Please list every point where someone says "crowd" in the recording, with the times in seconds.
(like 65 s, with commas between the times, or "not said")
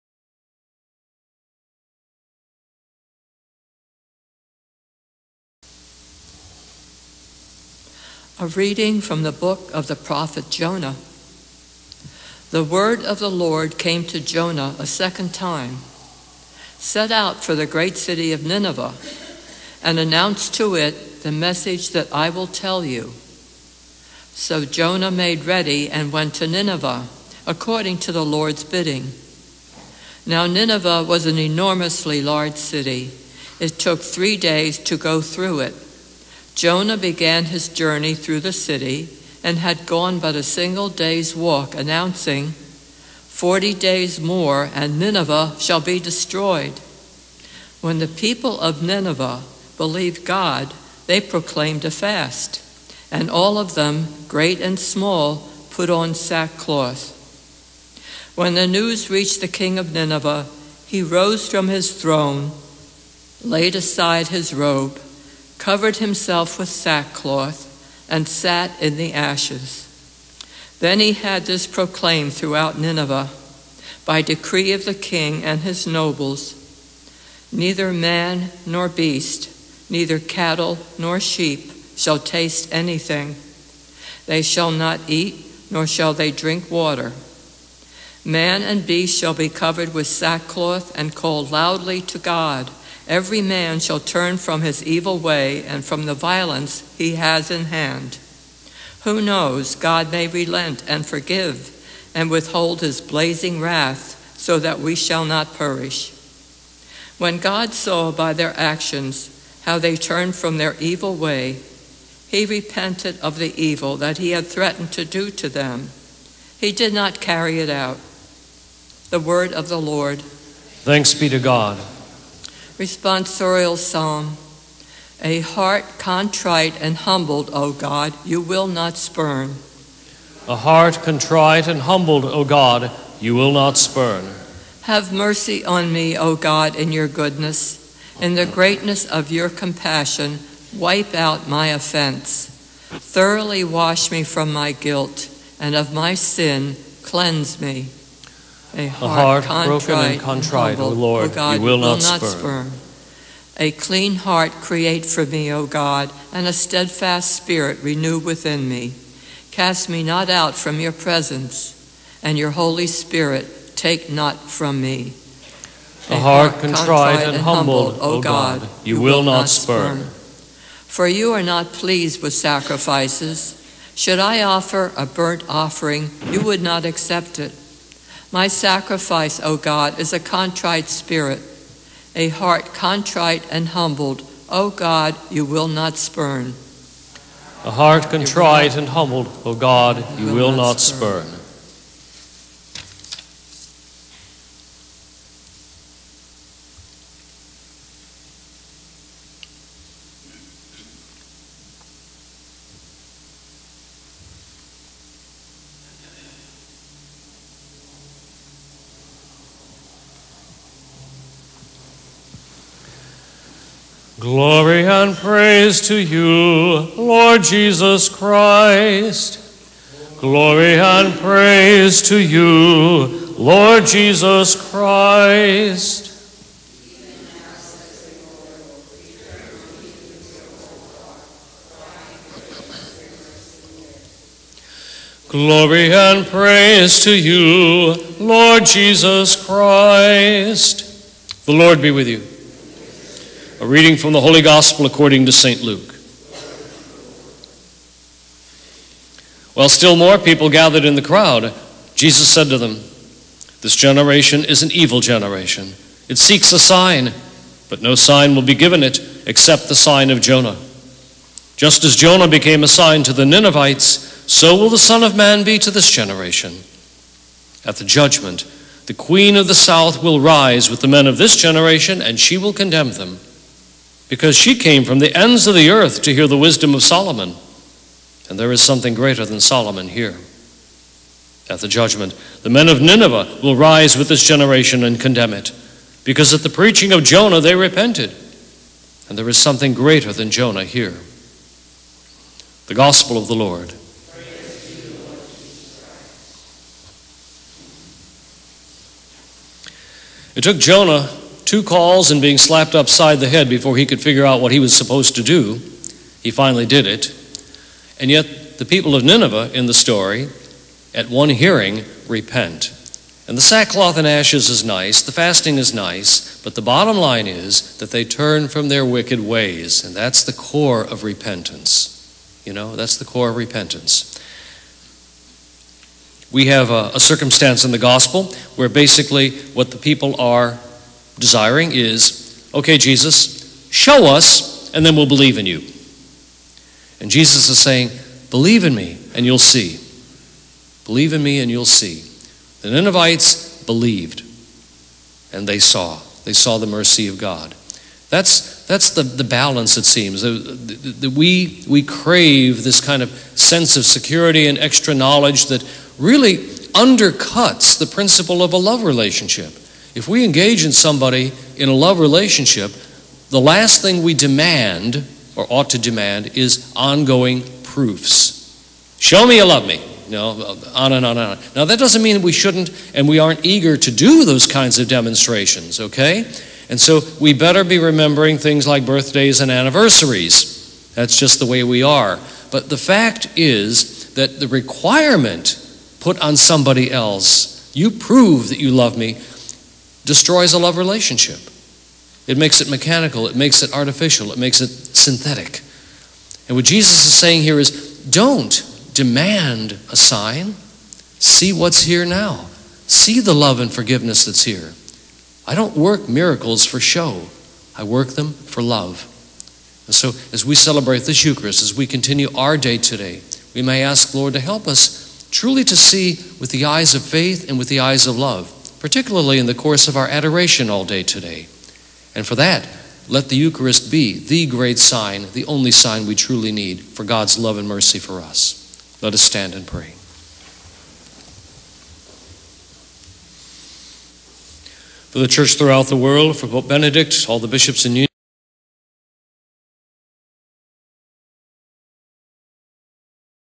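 251 s.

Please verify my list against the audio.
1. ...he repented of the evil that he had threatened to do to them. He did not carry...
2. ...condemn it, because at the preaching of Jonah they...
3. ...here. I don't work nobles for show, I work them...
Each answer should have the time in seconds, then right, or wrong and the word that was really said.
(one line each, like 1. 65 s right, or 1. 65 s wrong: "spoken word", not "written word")
1. 112 s right
2. 284 s right
3. 404 s wrong: "miracles", not "nobles".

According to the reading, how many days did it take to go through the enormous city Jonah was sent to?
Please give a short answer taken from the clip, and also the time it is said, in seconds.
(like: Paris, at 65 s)
3 days, at 34 s.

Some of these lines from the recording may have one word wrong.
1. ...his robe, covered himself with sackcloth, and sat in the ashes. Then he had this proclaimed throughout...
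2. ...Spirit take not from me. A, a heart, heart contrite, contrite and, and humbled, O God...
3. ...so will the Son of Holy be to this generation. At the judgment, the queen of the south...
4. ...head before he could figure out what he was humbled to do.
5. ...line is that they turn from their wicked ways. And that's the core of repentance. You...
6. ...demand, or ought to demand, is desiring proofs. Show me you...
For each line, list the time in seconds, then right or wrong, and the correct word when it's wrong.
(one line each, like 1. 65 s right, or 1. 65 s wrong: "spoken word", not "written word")
1. 64 s right
2. 162 s right
3. 264 s wrong: "Man", not "Holy"
4. 303 s wrong: "supposed", not "humbled"
5. 316 s right
6. 364 s wrong: "ongoing", not "desiring".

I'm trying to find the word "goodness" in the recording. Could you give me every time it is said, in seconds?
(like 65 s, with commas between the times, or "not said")
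137 s.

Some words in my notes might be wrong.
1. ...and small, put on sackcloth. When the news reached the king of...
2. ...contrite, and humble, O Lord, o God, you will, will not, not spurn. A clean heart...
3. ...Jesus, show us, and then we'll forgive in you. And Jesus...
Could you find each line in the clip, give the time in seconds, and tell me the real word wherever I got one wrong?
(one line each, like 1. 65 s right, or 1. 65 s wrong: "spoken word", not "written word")
1. 54 s right
2. 150 s right
3. 332 s wrong: "believe", not "forgive".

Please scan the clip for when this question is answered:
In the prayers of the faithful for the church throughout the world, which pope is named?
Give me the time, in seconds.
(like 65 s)
436 s.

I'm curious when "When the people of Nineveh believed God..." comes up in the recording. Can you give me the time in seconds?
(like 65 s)
47 s.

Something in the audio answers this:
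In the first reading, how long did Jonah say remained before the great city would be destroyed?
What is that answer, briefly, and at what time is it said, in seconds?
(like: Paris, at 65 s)
40 days, at 42 s.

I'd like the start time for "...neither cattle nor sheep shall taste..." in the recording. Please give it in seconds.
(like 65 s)
79 s.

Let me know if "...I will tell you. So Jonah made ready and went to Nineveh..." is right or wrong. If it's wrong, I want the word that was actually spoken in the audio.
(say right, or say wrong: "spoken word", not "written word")
right.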